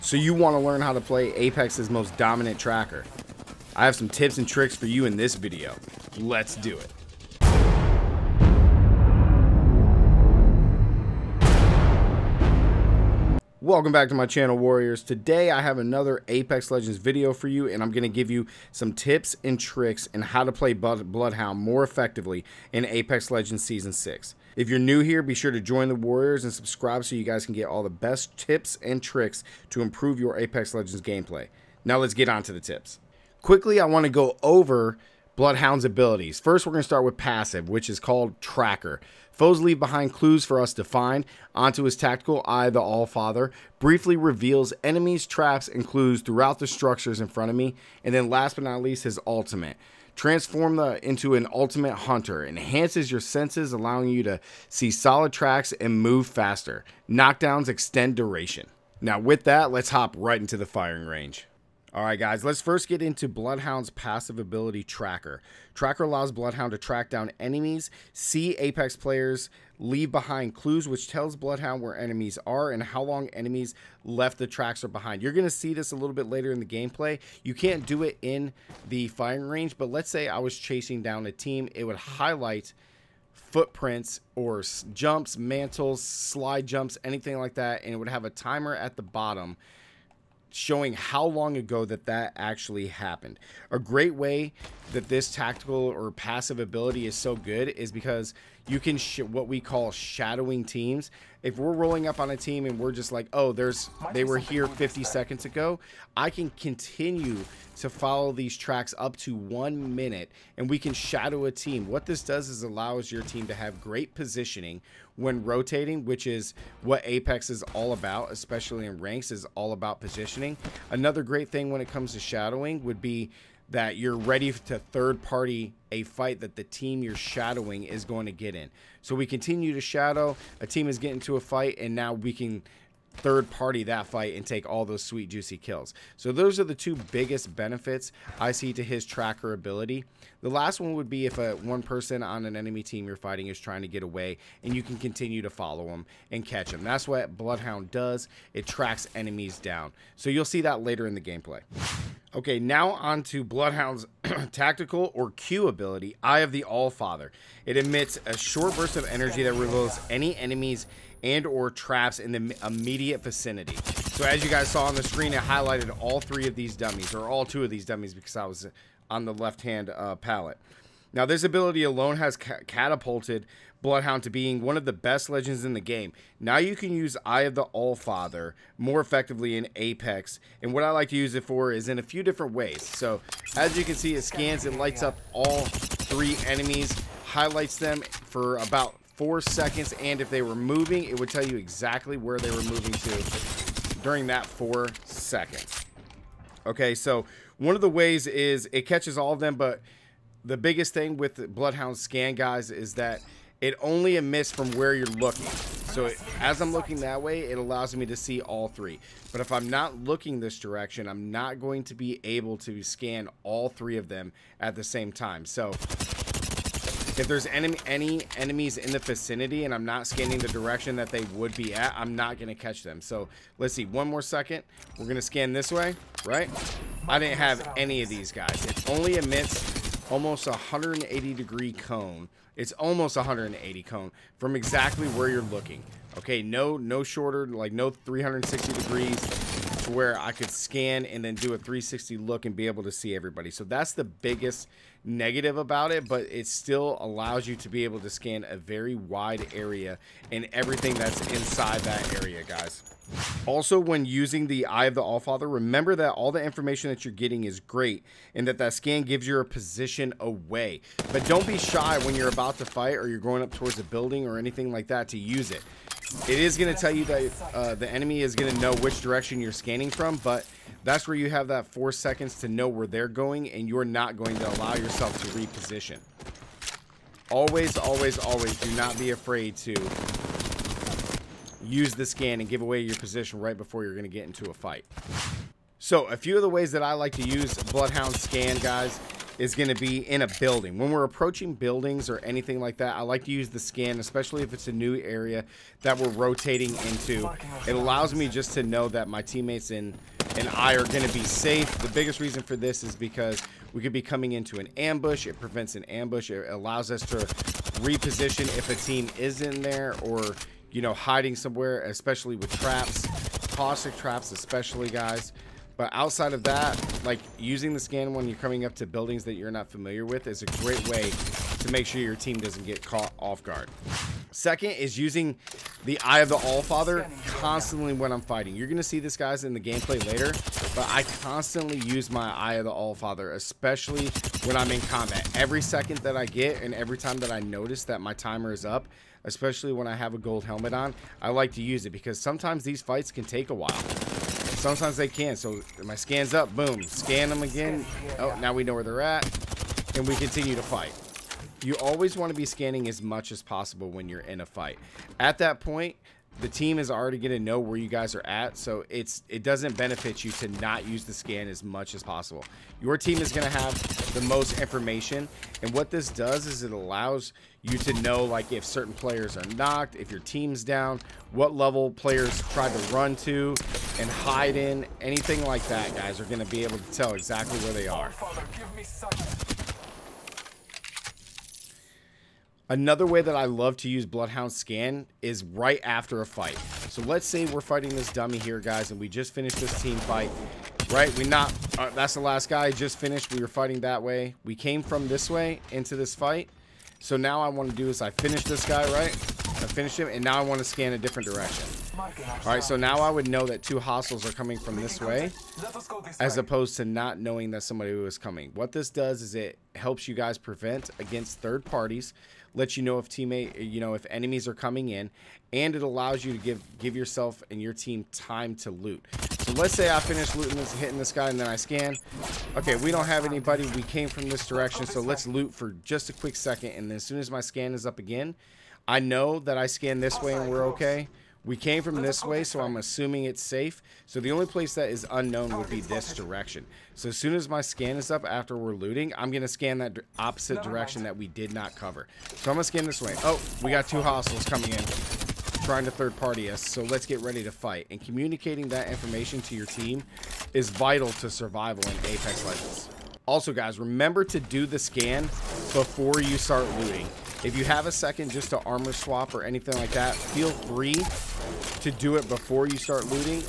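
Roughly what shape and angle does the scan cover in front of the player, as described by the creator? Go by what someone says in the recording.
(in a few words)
180 degree cone.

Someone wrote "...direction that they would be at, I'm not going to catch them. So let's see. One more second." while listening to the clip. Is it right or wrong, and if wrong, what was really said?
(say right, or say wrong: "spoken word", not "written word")
right.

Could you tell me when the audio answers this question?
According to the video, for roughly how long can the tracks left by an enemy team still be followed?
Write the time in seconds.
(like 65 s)
109 s.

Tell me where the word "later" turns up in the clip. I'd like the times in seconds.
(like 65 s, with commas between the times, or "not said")
76 s, 150 s, 330 s.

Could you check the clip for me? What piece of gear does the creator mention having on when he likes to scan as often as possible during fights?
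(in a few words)
gold helmet.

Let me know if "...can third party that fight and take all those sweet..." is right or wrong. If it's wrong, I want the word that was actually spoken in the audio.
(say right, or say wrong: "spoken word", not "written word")
right.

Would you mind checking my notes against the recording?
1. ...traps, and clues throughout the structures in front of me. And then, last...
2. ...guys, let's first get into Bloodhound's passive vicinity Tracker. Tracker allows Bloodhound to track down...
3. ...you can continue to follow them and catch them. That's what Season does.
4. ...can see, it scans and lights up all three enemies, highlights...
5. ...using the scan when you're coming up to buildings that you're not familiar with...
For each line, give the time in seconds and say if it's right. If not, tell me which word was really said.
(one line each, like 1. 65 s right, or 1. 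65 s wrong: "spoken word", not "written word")
1. 45 s right
2. 62 s wrong: "ability", not "vicinity"
3. 144 s wrong: "Bloodhound", not "Season"
4. 183 s right
5. 317 s right.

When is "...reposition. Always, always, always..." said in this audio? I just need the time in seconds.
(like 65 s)
275 s.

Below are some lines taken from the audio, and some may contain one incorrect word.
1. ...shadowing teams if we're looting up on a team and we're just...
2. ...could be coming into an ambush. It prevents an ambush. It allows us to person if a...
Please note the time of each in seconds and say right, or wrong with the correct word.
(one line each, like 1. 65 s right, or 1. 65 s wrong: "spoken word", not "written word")
1. 99 s wrong: "rolling", not "looting"
2. 303 s wrong: "reposition", not "person".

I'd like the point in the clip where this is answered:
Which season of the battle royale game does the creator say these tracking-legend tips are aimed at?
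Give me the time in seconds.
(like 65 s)
23 s.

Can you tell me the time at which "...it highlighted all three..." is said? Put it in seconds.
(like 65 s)
165 s.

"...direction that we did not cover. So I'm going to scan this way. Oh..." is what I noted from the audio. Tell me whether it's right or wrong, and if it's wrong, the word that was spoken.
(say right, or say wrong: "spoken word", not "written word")
right.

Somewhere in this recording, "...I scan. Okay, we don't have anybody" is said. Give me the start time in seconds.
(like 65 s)
421 s.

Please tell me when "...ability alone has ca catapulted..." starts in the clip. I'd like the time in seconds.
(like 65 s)
171 s.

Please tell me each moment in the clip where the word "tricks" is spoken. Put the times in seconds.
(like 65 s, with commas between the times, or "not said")
4 s, 19 s, 29 s.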